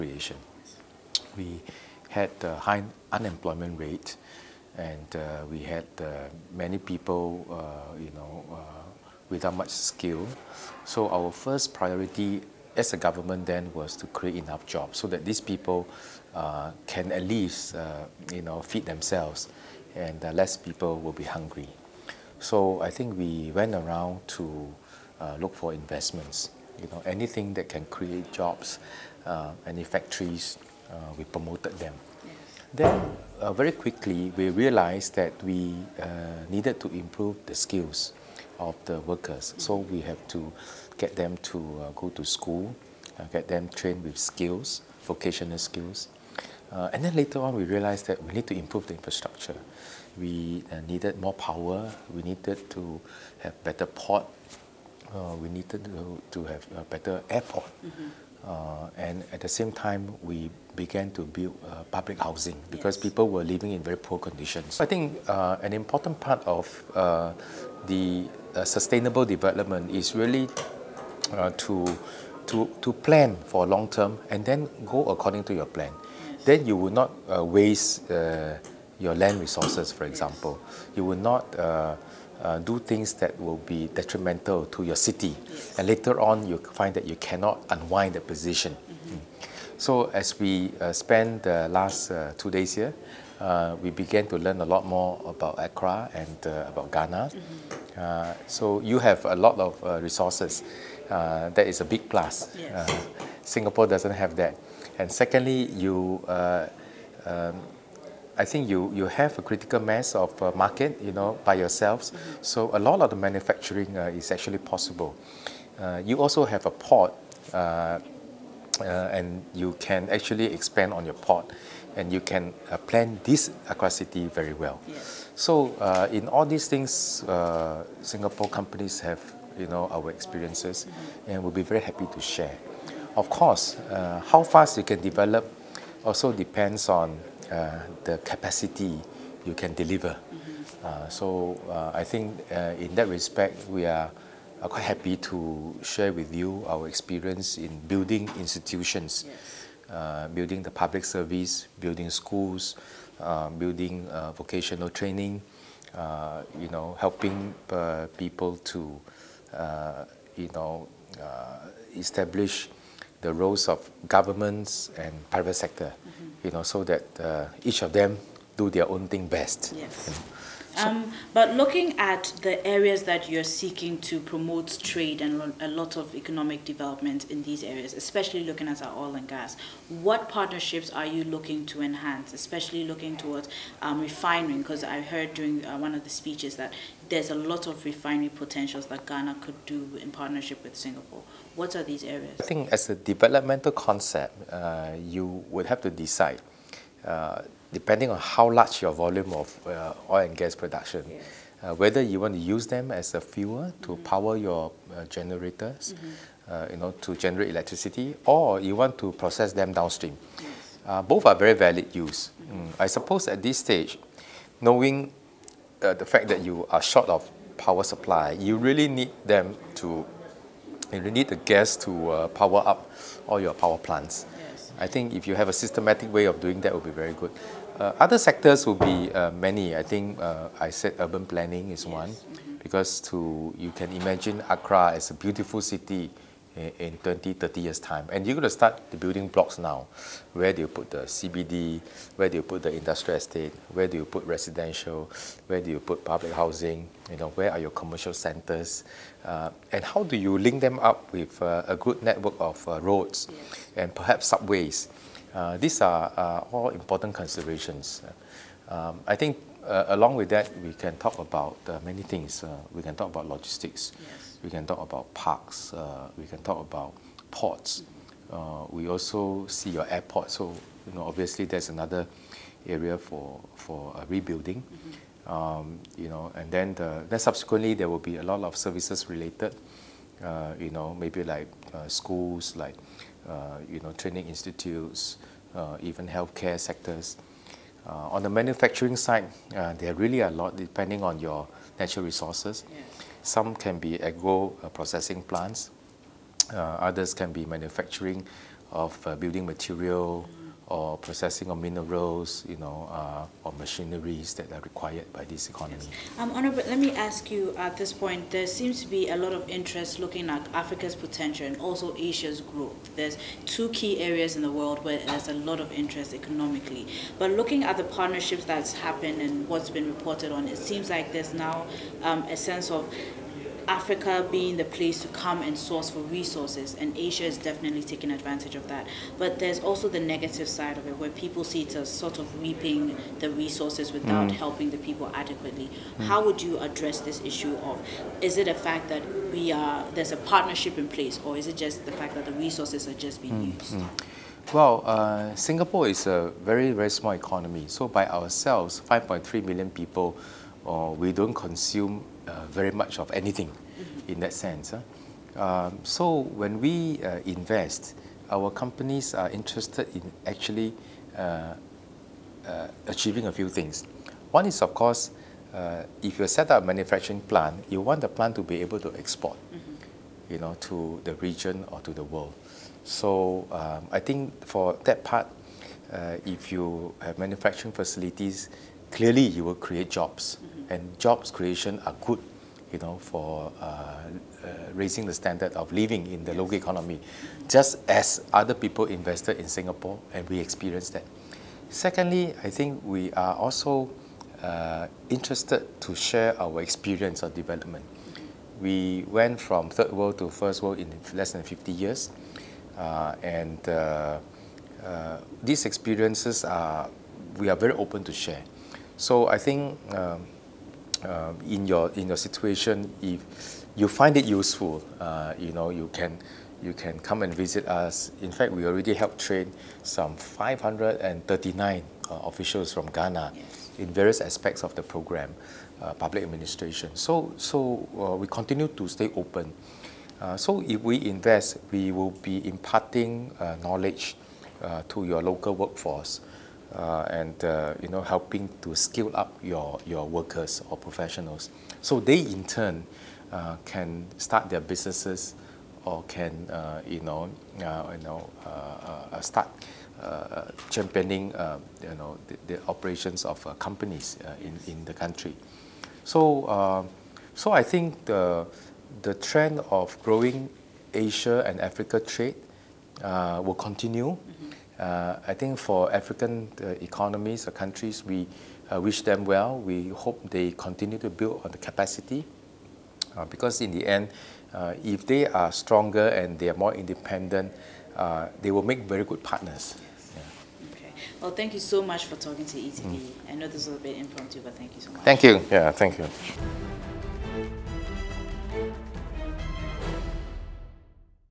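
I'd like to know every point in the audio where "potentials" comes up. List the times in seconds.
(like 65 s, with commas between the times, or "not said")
188 s, 310 s.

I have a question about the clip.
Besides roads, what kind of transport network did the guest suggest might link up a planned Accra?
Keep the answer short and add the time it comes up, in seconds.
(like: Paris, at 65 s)
subways, at 254 s.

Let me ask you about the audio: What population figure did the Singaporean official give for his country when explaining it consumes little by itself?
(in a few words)
5.3 million.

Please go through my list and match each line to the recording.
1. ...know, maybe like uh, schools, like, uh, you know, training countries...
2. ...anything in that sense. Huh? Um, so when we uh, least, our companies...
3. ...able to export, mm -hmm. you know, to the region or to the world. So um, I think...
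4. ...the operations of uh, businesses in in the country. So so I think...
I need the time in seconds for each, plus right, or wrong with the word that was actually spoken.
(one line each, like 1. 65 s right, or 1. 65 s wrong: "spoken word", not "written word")
1. 280 s wrong: "institutes", not "countries"
2. 353 s wrong: "invest", not "least"
3. 368 s right
4. 452 s wrong: "companies", not "businesses".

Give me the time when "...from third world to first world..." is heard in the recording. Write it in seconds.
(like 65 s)
399 s.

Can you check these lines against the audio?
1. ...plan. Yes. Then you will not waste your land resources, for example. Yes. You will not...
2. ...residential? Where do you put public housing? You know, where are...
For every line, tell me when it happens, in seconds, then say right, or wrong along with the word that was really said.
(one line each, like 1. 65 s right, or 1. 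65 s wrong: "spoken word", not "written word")
1. 75 s right
2. 244 s right.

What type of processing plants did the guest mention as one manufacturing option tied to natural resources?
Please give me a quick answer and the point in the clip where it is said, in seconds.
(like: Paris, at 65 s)
agro processing plants, at 294 s.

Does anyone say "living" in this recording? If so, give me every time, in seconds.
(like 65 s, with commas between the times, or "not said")
63 s, 385 s.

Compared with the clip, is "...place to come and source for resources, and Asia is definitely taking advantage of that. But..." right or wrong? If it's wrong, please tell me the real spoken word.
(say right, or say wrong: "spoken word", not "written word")
right.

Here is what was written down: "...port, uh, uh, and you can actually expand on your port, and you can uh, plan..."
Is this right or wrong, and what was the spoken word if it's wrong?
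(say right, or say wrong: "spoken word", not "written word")
right.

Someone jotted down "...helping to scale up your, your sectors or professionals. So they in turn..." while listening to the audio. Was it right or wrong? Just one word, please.
wrong.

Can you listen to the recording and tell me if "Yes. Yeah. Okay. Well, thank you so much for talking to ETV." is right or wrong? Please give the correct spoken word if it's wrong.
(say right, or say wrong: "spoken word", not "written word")
right.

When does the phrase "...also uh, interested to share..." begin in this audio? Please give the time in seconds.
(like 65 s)
393 s.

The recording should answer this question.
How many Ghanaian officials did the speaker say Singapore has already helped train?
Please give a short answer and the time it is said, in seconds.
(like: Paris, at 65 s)
539, at 420 s.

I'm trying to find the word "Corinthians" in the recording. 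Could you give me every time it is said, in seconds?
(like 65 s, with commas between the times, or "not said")
not said.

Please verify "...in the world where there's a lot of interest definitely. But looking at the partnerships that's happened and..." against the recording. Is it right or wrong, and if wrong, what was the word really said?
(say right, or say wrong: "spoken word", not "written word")
wrong: "economically", not "definitely".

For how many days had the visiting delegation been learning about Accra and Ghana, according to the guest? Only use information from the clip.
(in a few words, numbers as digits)
two days.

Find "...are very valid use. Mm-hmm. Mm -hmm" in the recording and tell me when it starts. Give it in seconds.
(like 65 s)
211 s.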